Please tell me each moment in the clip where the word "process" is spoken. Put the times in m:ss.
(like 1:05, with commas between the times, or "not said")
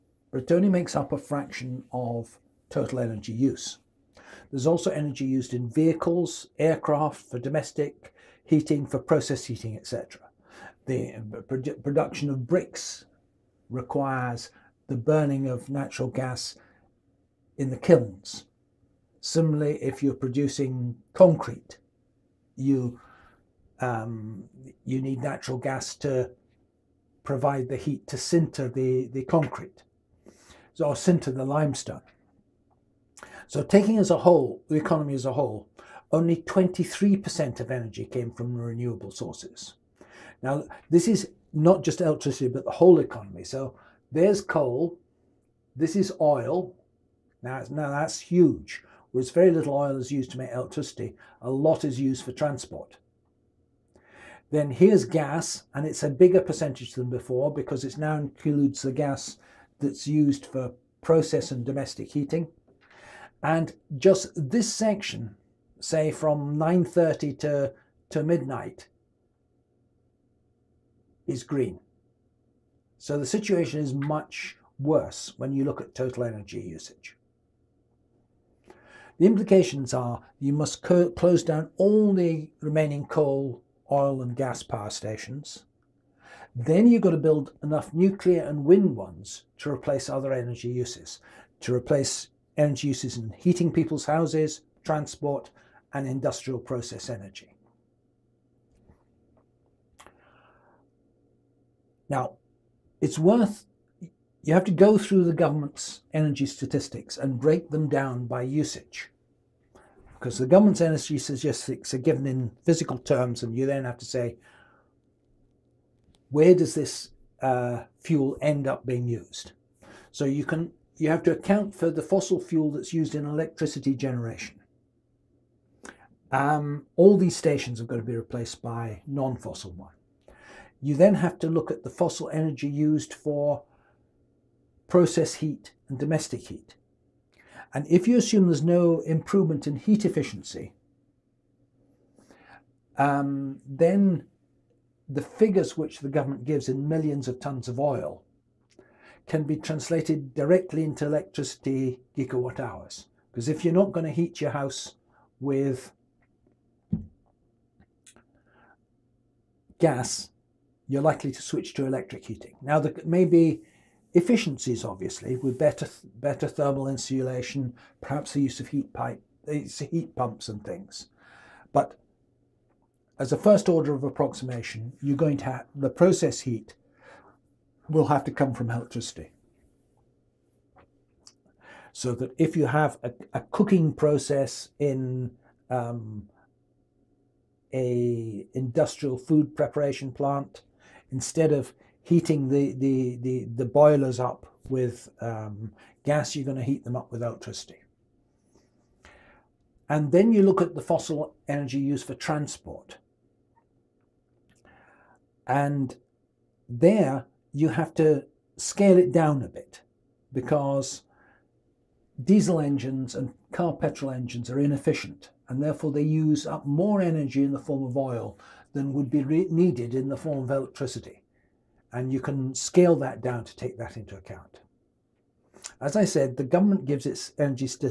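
0:08, 1:01, 1:36, 2:14, 2:55, 3:03.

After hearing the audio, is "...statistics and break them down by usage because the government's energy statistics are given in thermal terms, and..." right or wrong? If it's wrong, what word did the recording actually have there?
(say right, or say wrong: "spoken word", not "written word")
wrong: "physical", not "thermal".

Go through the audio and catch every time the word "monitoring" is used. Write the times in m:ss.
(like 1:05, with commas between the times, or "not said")
not said.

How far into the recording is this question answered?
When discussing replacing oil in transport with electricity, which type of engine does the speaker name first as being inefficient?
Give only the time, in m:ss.
3:32.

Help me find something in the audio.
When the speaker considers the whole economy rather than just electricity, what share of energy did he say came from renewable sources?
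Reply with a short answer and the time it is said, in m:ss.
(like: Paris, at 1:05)
23%, at 0:36.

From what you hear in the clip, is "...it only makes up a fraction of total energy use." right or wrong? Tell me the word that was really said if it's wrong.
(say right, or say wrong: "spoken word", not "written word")
right.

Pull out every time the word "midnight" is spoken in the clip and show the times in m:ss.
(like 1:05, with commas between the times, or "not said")
1:08.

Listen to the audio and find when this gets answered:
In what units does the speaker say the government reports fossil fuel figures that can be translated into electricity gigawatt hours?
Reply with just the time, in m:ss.
2:26.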